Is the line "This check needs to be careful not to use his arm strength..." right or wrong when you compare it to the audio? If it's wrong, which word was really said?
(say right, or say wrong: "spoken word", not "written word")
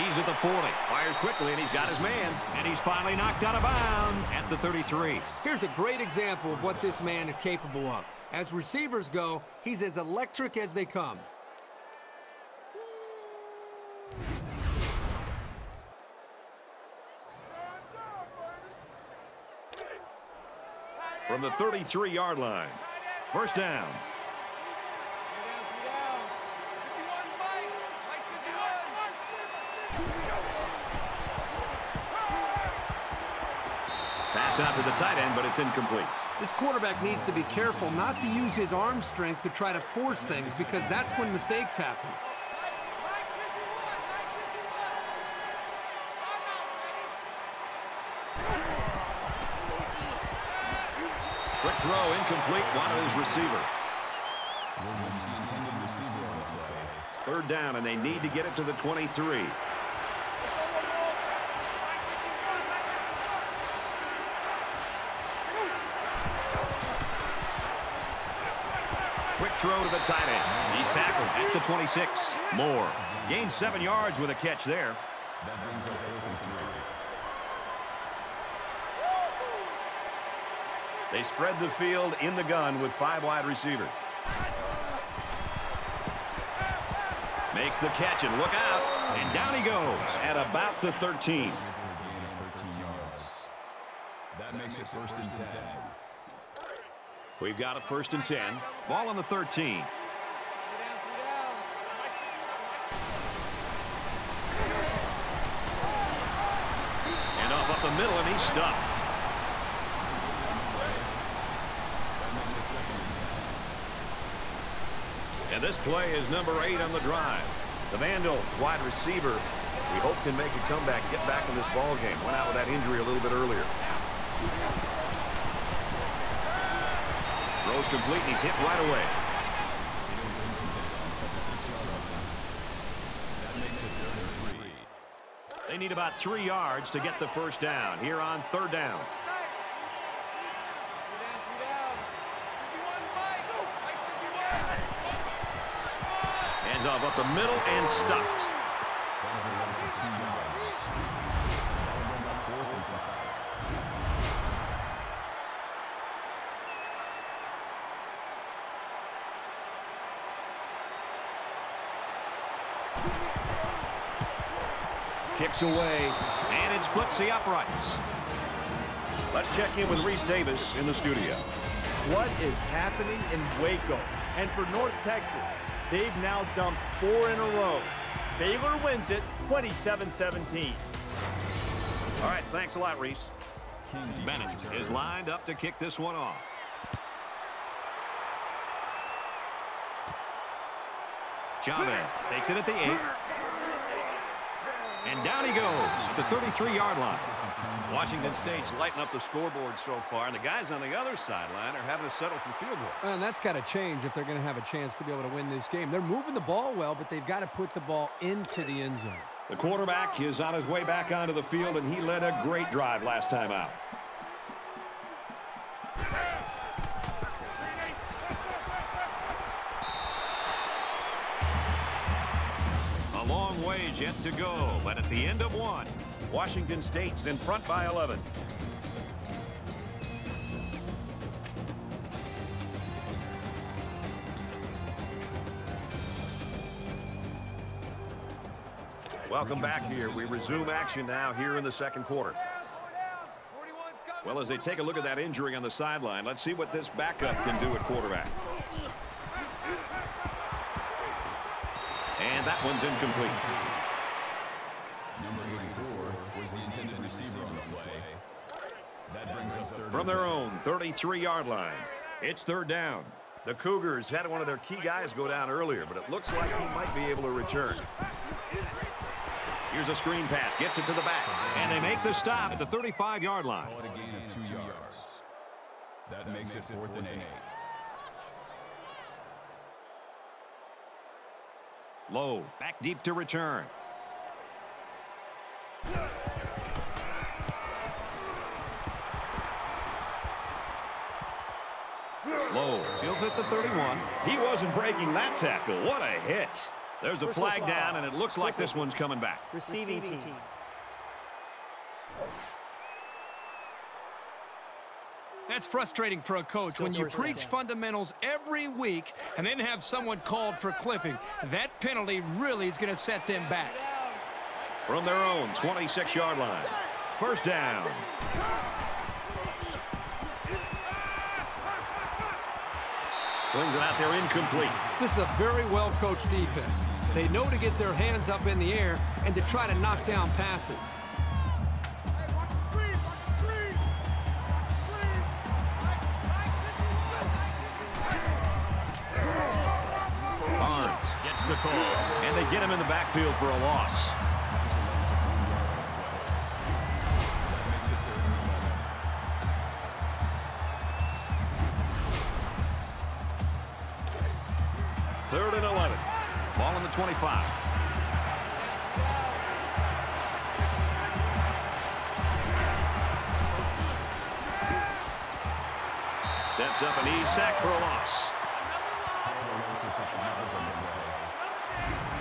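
wrong: "quarterback", not "check".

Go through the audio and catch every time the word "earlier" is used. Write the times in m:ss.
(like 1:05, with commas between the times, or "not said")
2:03, 4:25.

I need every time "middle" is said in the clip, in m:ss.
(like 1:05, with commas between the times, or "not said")
1:47, 2:27.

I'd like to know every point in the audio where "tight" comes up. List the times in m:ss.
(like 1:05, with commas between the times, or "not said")
0:34, 1:09.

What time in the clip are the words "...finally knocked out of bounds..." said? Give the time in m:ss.
0:02.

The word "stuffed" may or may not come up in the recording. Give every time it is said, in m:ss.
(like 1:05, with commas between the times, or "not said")
1:48, 2:27.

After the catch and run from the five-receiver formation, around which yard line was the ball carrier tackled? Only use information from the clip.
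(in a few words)
13.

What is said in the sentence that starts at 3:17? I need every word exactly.
Washington State's lighting up the scoreboard so far, and the guys on the other sideline are having to settle for field goals.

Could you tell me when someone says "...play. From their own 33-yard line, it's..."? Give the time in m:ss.
4:17.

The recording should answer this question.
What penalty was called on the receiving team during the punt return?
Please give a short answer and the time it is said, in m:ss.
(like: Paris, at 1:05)
Clipping, at 5:10.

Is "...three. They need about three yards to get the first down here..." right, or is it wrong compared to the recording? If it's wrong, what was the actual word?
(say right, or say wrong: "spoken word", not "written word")
right.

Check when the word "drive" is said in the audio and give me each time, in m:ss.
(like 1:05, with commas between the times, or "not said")
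1:57, 3:32.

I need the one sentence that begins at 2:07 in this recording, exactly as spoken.
Throws complete, and he's hit right away.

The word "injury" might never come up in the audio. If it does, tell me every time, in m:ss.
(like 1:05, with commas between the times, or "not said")
2:02, 4:05.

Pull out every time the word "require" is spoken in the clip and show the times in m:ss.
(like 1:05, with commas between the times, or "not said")
not said.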